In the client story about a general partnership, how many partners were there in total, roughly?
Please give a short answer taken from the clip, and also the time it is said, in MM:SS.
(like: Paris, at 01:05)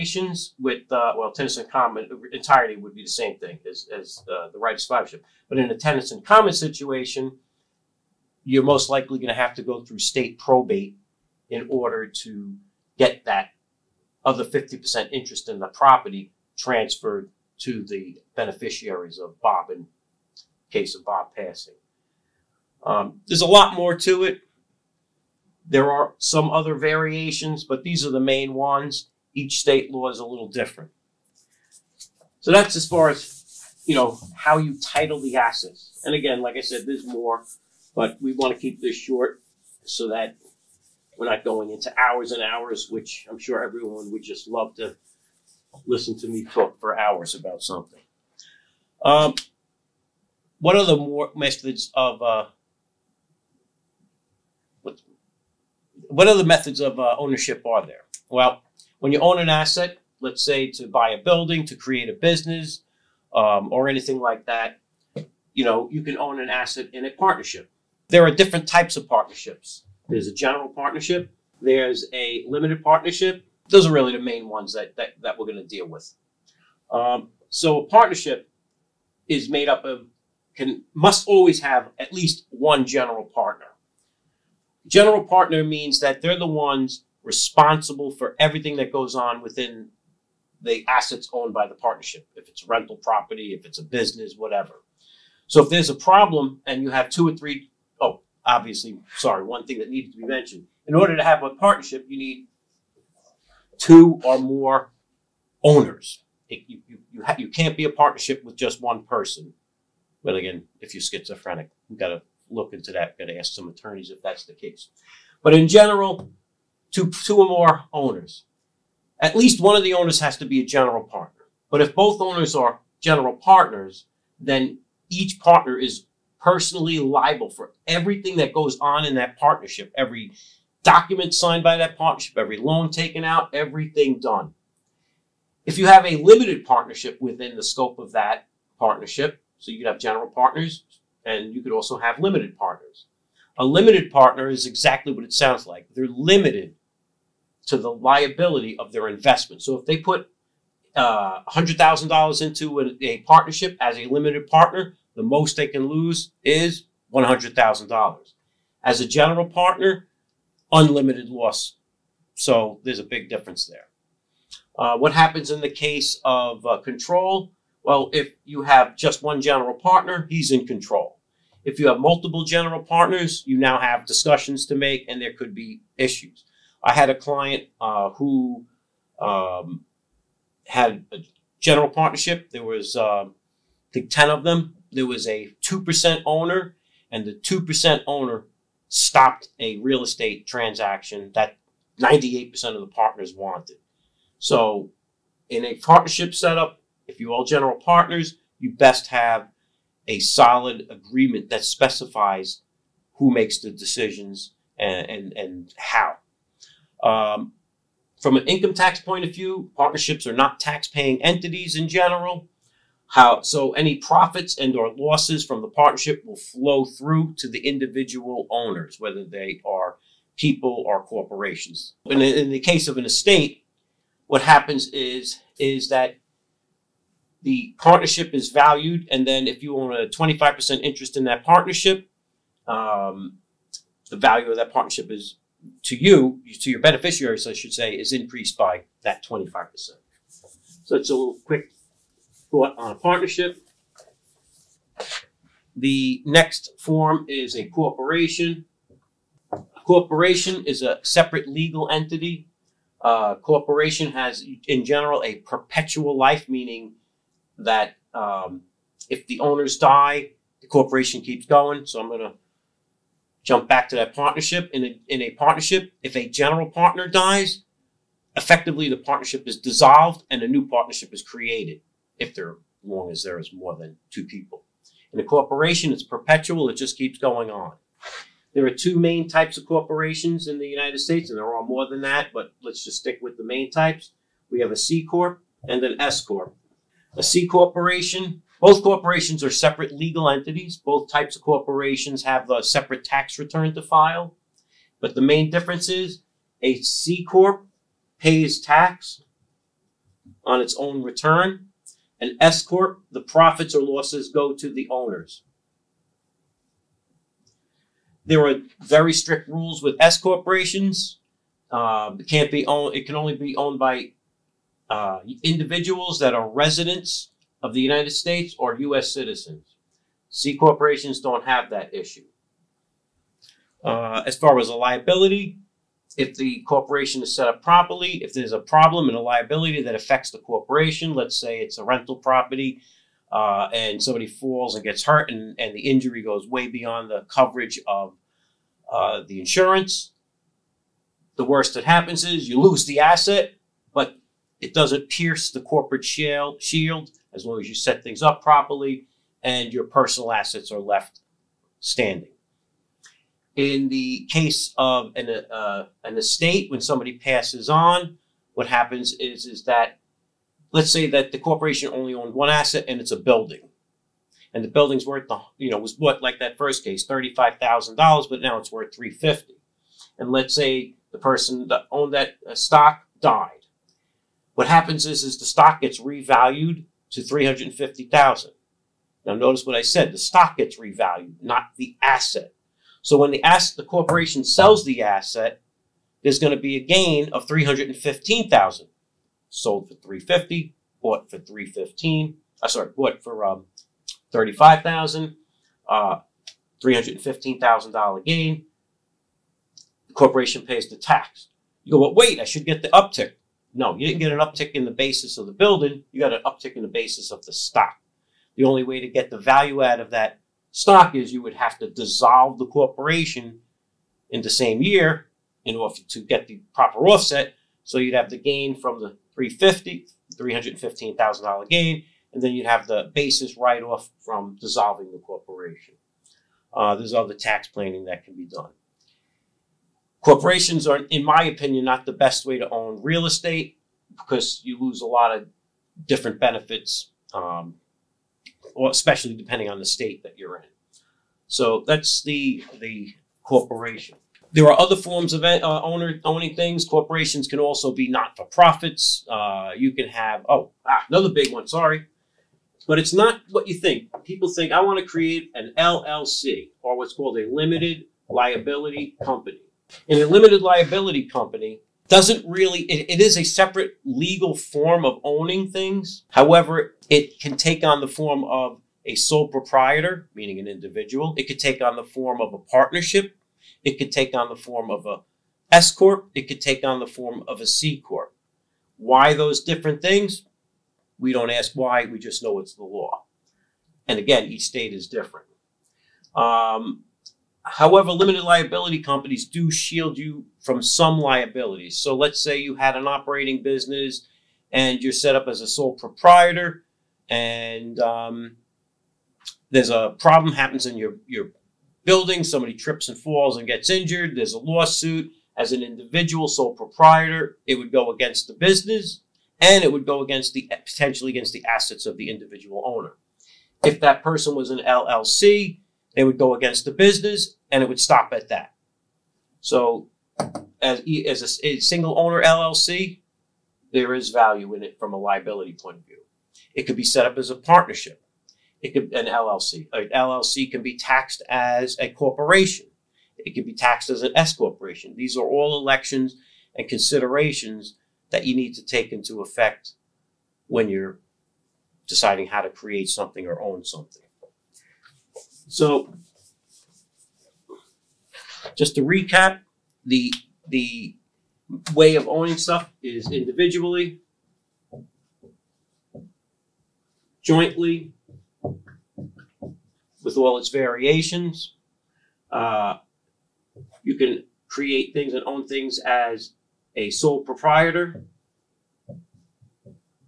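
10, at 03:04.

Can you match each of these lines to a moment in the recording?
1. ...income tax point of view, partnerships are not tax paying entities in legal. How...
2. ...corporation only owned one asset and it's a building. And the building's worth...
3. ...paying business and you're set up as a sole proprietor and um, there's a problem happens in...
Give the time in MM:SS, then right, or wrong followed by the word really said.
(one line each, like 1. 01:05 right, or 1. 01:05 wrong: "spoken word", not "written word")
1. 03:28 wrong: "general", not "legal"
2. 06:01 right
3. 08:13 wrong: "operating", not "paying".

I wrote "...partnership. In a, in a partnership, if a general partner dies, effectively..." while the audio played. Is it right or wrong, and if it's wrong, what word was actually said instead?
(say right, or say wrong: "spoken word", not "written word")
right.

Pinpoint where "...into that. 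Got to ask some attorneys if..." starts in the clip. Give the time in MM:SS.
01:52.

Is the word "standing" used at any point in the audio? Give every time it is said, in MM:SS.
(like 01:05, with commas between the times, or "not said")
05:51.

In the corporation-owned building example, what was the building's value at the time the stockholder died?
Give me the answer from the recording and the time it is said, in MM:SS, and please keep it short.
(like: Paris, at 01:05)
350,000, at 06:17.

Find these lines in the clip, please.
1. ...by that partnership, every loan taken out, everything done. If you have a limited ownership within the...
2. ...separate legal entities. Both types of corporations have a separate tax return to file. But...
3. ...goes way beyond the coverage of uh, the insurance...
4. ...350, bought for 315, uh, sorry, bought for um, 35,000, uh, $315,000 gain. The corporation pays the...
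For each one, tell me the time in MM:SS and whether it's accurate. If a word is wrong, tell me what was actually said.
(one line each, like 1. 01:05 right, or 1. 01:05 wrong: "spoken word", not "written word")
1. 02:11 wrong: "partnership", not "ownership"
2. 04:49 right
3. 05:36 right
4. 06:29 right.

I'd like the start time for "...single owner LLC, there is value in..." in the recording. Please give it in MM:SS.
08:41.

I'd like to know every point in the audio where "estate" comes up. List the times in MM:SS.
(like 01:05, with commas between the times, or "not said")
03:10, 03:43, 05:56, 07:13.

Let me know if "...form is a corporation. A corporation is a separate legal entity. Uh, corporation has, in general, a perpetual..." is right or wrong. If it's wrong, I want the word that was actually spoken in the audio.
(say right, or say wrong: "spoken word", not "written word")
right.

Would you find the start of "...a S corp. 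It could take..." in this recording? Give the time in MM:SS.
07:55.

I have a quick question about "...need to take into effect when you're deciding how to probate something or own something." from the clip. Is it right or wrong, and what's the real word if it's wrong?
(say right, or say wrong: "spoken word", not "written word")
wrong: "create", not "probate".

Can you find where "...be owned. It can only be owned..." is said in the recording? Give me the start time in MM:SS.
05:12.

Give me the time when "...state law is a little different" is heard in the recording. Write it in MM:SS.
00:29.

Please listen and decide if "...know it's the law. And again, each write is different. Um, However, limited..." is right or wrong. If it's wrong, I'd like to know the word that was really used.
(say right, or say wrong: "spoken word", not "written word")
wrong: "state", not "write".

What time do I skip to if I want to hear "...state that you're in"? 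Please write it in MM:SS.
07:19.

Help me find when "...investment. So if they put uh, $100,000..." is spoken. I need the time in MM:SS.
02:29.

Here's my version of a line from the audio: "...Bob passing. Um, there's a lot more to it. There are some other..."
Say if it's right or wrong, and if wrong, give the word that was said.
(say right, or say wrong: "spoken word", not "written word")
right.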